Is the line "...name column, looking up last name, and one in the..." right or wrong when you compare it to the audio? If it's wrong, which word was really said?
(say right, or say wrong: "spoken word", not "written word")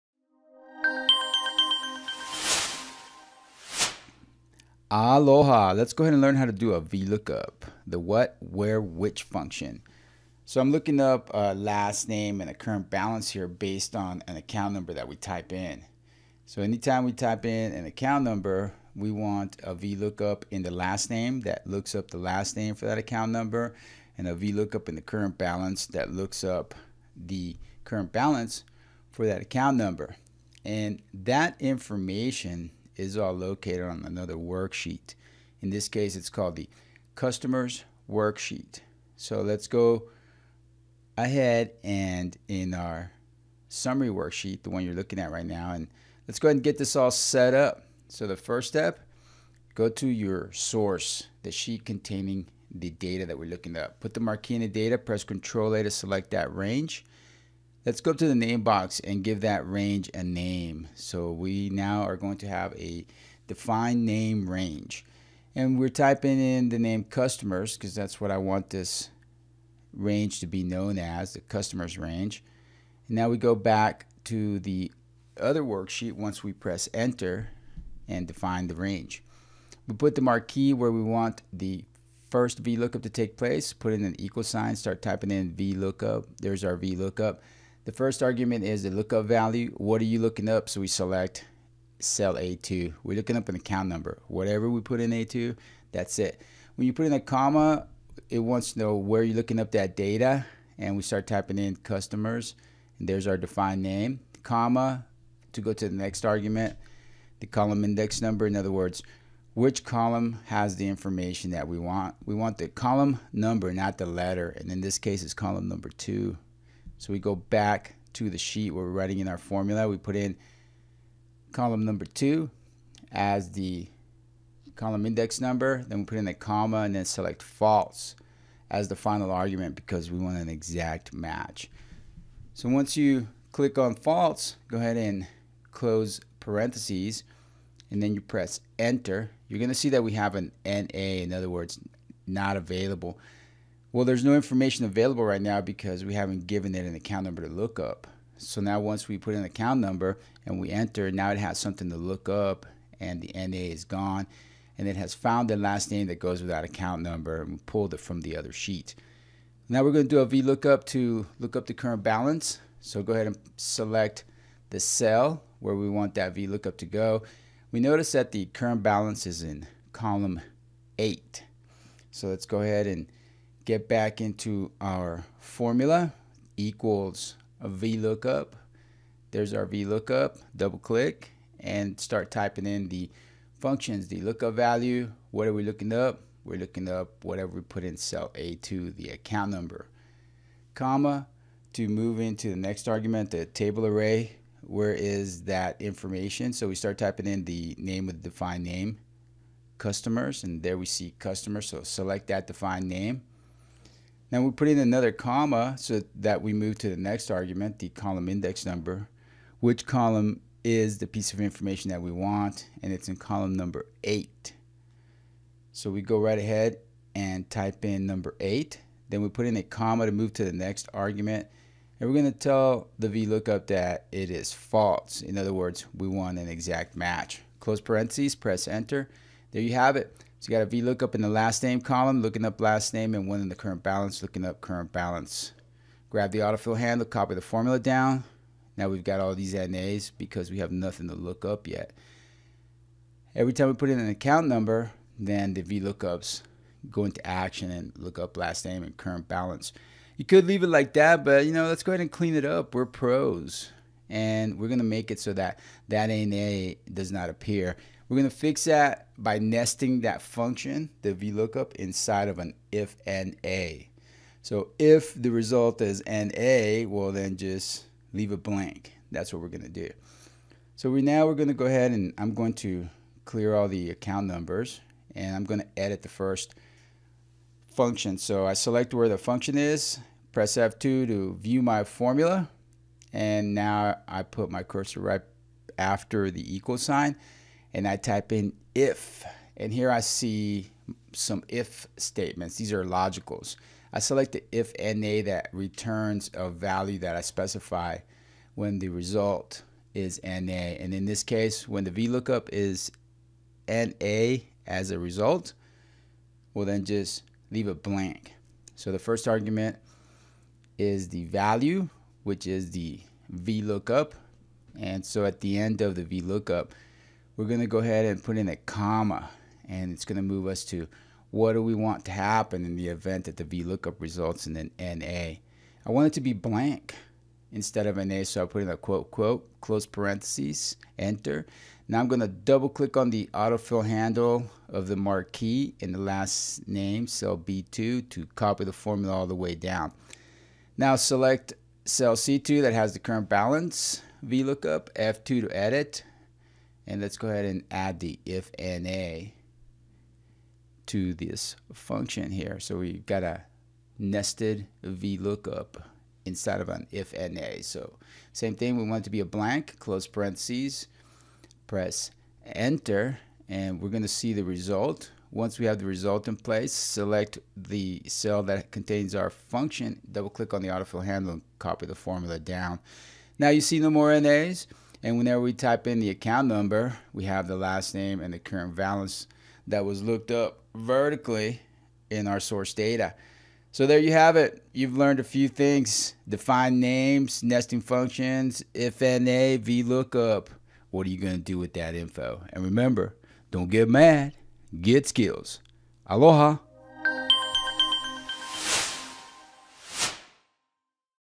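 right.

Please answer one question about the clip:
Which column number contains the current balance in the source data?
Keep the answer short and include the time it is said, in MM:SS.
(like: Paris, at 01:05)
8, at 02:48.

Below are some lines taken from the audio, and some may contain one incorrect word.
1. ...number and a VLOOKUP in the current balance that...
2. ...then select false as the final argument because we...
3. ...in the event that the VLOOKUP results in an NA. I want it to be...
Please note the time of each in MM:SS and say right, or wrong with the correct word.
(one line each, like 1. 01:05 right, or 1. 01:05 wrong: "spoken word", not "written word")
1. 00:23 right
2. 02:06 right
3. 05:22 right.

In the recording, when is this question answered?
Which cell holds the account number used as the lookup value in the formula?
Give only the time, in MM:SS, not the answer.
01:30.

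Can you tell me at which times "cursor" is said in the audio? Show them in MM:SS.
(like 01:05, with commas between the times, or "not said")
04:44.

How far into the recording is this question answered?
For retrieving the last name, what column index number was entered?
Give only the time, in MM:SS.
01:55.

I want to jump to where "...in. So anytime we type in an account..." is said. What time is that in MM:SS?
00:15.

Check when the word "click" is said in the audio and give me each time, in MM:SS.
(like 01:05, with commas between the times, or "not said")
02:13, 03:00, 05:32, 06:10.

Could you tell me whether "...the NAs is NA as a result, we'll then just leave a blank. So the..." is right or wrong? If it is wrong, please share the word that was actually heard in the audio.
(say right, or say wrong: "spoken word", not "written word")
wrong: "VLOOKUP", not "NAs".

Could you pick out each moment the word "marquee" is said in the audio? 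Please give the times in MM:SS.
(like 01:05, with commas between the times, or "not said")
00:54, 01:20, 05:34.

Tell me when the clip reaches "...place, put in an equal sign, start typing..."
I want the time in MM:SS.
01:23.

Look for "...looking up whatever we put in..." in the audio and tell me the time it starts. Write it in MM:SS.
03:06.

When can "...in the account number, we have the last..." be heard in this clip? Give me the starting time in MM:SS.
06:15.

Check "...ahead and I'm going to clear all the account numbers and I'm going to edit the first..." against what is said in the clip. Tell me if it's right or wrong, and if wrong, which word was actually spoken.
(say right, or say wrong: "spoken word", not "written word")
right.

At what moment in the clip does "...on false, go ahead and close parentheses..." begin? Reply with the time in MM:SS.
02:13.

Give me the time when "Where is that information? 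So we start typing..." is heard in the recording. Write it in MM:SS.
03:14.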